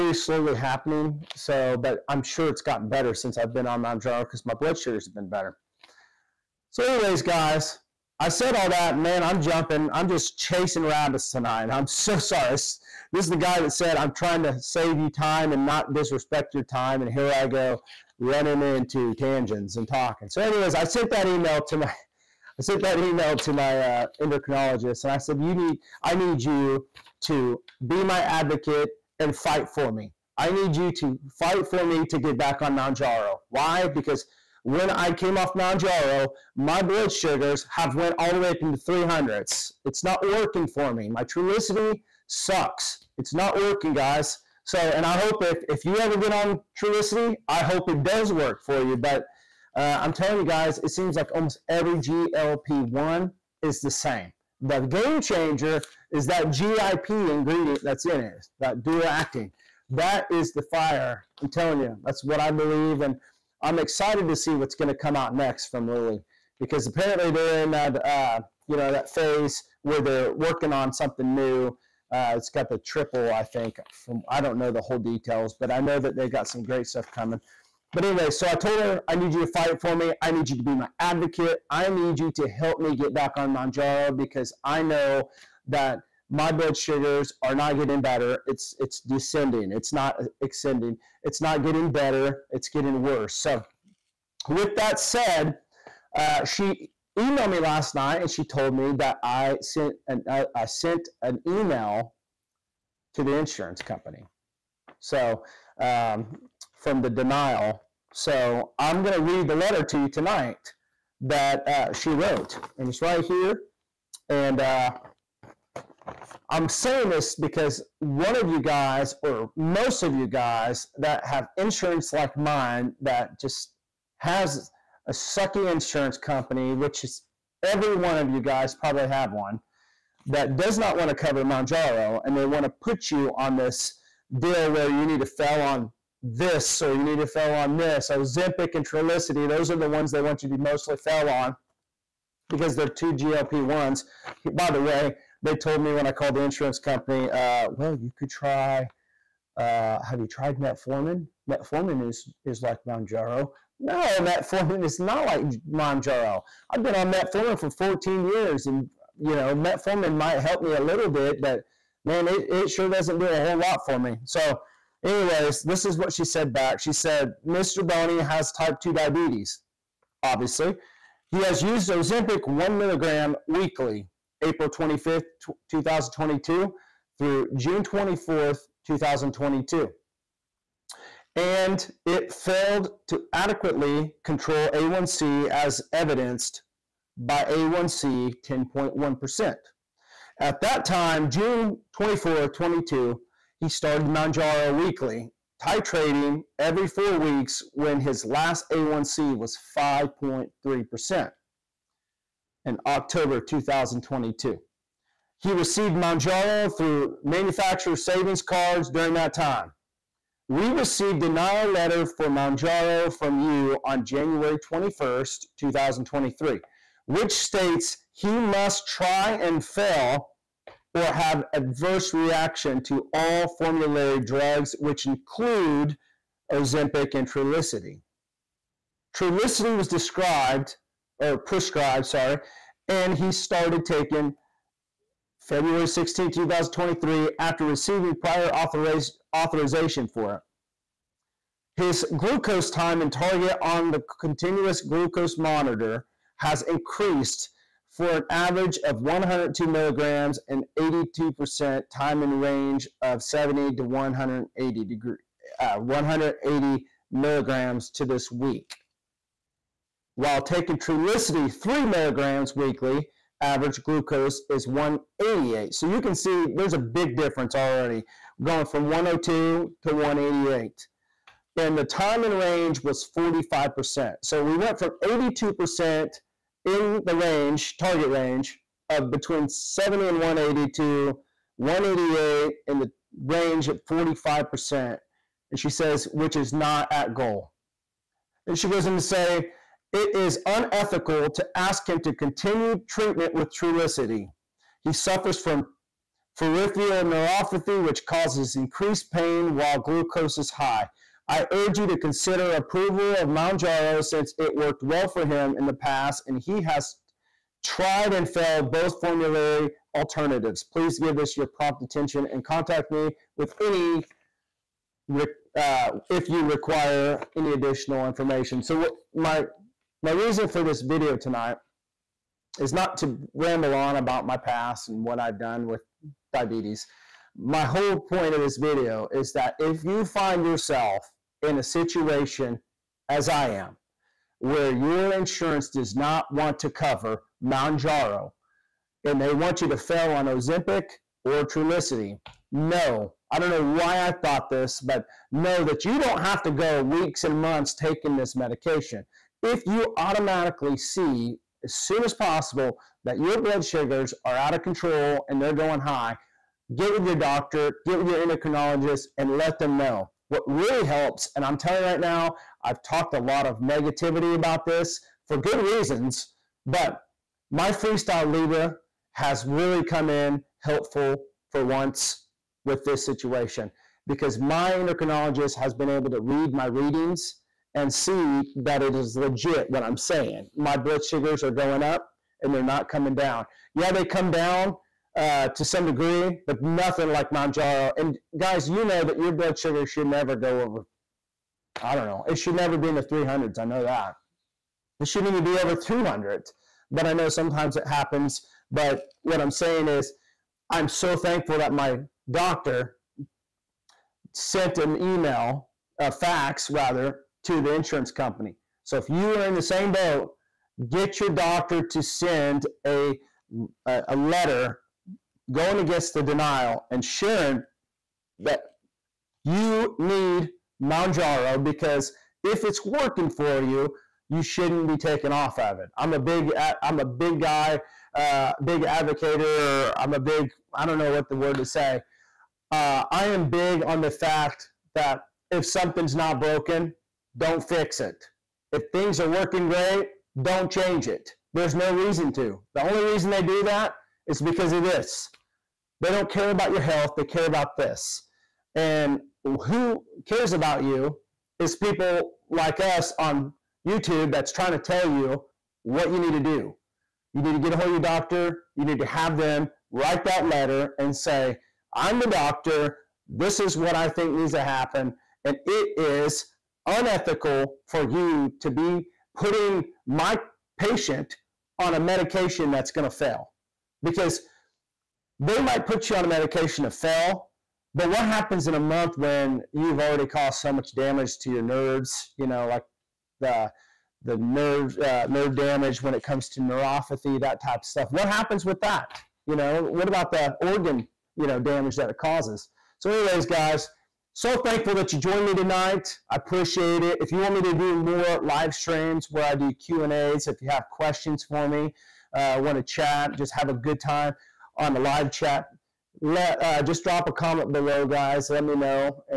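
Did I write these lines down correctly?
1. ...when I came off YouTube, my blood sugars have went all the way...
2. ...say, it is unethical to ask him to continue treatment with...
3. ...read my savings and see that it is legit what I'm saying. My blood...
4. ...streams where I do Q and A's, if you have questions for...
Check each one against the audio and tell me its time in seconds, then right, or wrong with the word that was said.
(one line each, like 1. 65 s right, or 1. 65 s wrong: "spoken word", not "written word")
1. 34 s wrong: "Mounjaro", not "YouTube"
2. 289 s right
3. 376 s wrong: "readings", not "savings"
4. 498 s right.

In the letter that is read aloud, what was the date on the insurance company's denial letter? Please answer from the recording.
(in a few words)
January 21, 2023.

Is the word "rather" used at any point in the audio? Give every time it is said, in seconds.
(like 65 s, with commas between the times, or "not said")
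406 s.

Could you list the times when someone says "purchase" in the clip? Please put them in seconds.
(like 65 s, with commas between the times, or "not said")
not said.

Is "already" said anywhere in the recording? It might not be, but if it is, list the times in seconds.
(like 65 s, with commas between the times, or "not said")
267 s, 479 s.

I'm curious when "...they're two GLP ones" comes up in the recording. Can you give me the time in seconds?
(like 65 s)
142 s.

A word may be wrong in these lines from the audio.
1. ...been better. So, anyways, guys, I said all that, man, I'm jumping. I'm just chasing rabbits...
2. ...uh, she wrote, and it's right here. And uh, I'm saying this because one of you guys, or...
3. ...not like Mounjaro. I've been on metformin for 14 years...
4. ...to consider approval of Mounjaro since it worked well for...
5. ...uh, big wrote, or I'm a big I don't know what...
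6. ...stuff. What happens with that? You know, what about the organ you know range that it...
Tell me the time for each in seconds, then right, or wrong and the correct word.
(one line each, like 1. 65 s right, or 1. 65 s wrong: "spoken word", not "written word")
1. 5 s right
2. 111 s right
3. 154 s right
4. 301 s right
5. 428 s wrong: "advocate", not "wrote"
6. 487 s wrong: "damage", not "range".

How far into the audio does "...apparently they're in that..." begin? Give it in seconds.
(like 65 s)
66 s.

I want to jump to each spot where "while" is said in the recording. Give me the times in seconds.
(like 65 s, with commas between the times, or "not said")
260 s, 299 s.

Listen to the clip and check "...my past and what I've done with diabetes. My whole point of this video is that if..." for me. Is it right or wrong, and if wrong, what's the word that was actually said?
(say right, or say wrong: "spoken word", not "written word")
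right.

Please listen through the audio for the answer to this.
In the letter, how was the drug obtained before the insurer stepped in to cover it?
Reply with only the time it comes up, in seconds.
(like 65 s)
207 s.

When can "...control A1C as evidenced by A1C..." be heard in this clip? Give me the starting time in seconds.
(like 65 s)
184 s.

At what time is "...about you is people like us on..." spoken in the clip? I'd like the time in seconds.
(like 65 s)
450 s.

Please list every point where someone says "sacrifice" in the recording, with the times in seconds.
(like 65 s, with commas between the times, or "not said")
not said.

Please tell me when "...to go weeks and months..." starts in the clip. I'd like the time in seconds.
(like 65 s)
346 s.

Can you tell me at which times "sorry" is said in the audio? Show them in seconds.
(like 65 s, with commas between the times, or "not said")
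12 s, 232 s.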